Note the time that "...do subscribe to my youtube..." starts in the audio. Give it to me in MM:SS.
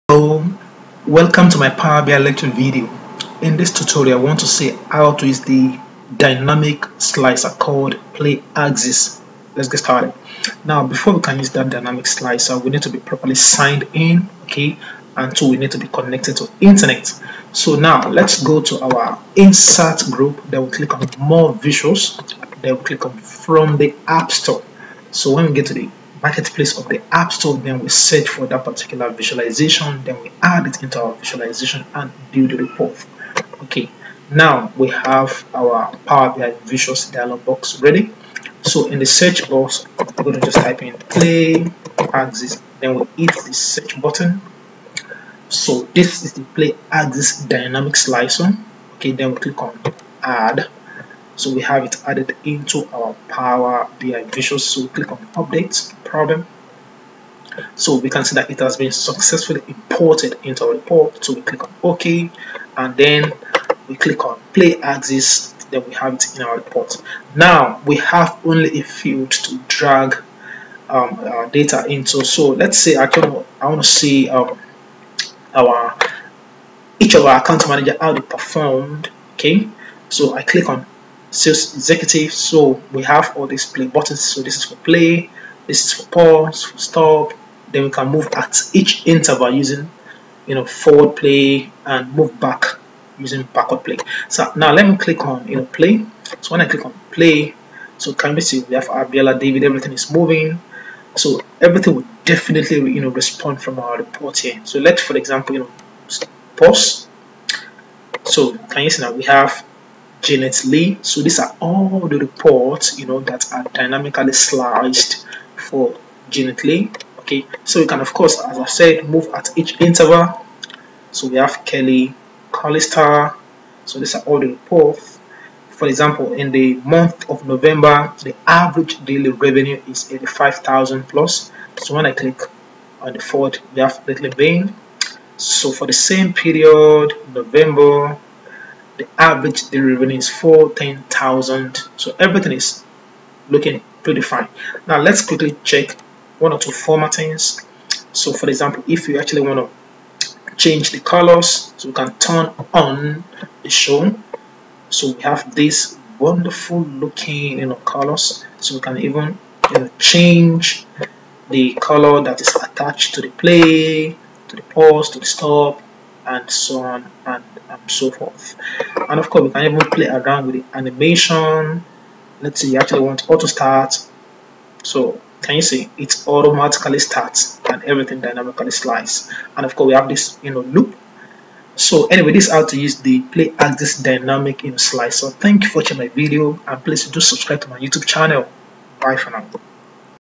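03:07.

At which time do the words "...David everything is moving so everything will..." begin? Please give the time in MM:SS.
01:39.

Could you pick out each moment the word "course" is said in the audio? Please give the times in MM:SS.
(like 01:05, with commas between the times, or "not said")
01:58, 02:49, 02:59.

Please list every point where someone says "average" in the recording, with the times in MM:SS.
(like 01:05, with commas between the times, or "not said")
02:08, 02:19.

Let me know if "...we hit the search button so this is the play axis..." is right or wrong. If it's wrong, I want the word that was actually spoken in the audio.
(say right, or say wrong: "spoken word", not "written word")
right.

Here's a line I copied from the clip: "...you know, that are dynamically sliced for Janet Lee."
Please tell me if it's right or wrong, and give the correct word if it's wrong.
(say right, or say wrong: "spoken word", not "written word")
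right.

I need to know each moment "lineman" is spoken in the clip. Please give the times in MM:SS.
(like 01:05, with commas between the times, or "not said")
not said.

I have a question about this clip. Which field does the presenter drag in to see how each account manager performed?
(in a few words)
sales executive.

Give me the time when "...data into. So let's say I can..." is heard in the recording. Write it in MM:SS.
01:11.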